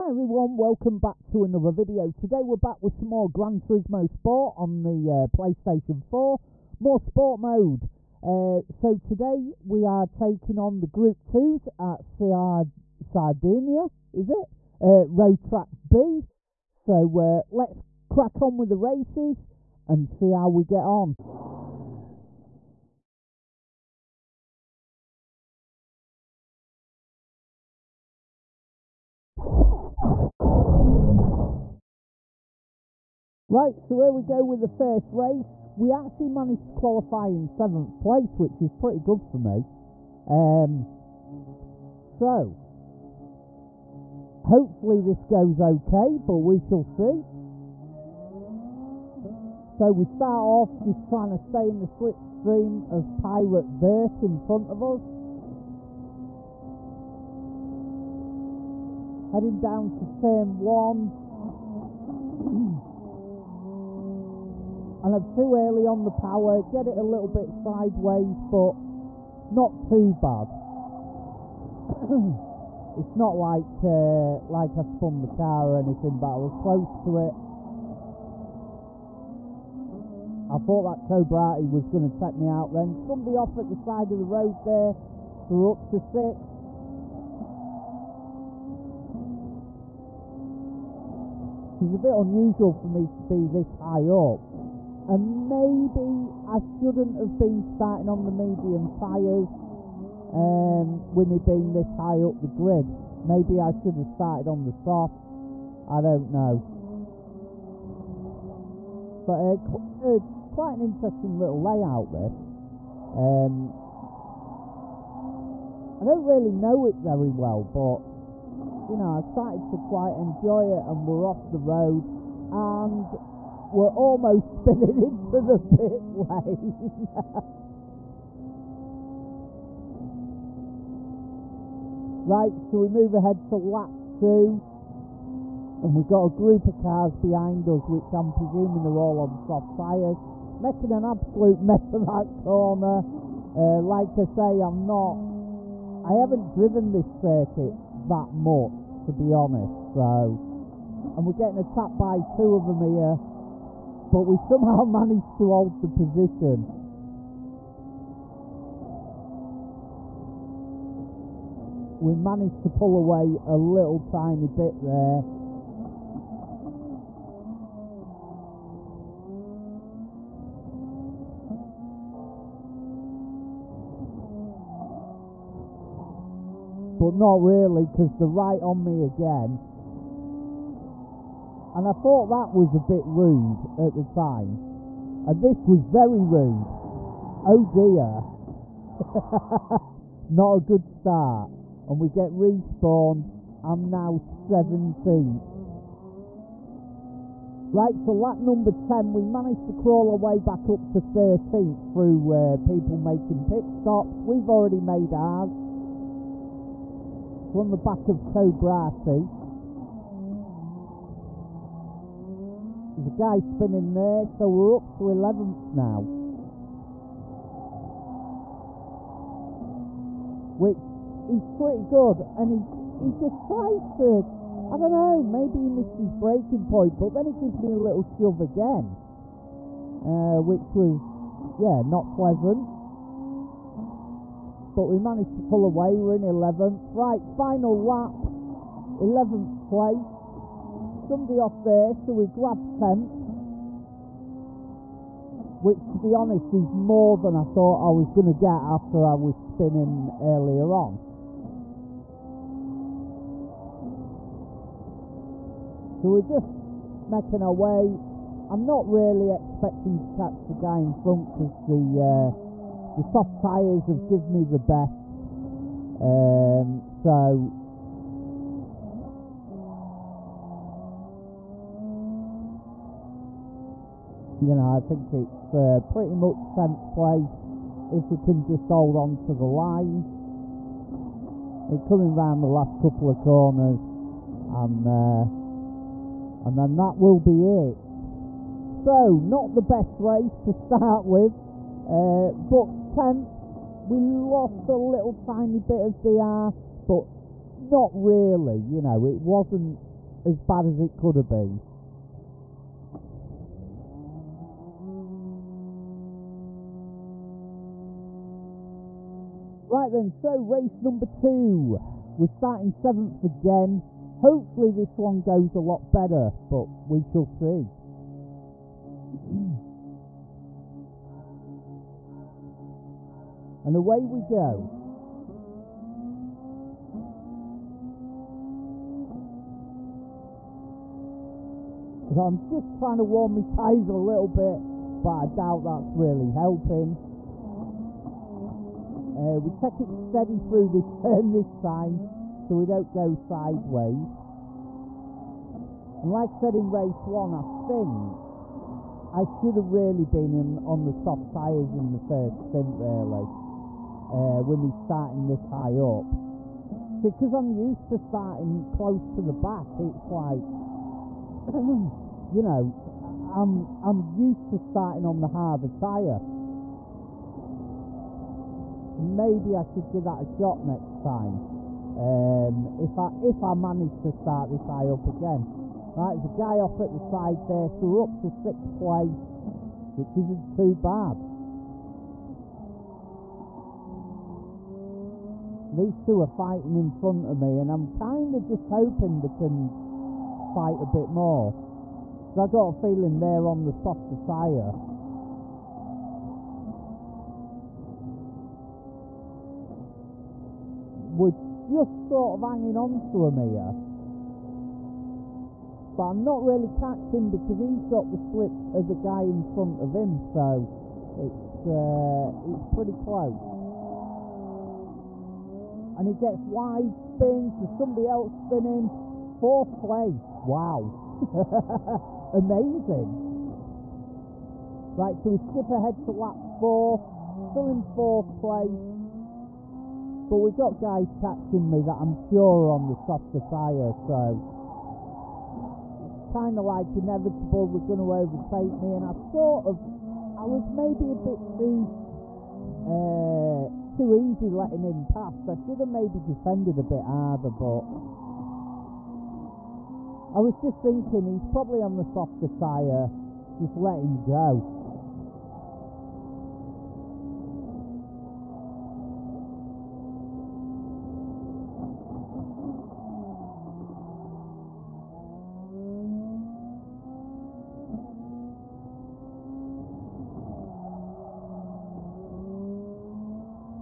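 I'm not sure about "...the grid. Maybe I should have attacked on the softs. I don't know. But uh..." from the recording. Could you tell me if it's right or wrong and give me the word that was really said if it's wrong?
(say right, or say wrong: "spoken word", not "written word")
wrong: "started", not "attacked".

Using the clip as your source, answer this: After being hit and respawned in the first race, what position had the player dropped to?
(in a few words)
17.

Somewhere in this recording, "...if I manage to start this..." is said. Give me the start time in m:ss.
6:13.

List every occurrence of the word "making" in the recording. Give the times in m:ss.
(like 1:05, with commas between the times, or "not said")
2:20, 3:22, 4:17.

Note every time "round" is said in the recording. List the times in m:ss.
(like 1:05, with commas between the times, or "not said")
4:42.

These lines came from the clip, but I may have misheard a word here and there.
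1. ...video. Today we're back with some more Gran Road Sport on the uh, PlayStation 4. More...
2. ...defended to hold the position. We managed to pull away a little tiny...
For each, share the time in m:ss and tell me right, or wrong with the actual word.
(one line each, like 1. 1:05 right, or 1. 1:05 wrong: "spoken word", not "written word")
1. 0:01 wrong: "Turismo", not "Road"
2. 2:34 wrong: "managed", not "defended".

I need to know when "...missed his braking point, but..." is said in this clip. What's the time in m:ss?
3:45.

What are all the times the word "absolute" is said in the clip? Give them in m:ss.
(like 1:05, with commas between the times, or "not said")
2:21.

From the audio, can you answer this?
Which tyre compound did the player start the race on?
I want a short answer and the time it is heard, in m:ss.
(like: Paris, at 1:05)
medium, at 1:38.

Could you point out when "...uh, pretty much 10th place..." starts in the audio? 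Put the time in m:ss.
4:35.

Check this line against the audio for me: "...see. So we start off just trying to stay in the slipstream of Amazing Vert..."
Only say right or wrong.
wrong.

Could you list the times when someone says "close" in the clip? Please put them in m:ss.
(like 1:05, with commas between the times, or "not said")
1:16, 5:58, 6:52.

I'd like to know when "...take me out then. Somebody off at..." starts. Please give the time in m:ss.
1:22.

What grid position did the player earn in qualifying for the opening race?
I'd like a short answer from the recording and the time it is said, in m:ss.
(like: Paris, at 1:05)
7th, at 0:37.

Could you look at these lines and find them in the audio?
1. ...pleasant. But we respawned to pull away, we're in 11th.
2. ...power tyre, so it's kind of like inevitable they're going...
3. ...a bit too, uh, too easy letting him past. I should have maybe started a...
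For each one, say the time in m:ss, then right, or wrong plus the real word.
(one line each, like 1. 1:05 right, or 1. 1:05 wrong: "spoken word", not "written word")
1. 3:52 wrong: "managed", not "respawned"
2. 7:12 wrong: "softer", not "power"
3. 7:21 wrong: "defended", not "started".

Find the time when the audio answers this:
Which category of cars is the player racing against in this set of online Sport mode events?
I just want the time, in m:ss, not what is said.
0:10.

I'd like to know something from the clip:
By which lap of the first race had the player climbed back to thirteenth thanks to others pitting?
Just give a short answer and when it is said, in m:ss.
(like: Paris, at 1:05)
10, at 3:18.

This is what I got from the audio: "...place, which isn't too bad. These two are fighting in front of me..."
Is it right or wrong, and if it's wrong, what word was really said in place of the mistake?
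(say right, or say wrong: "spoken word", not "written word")
right.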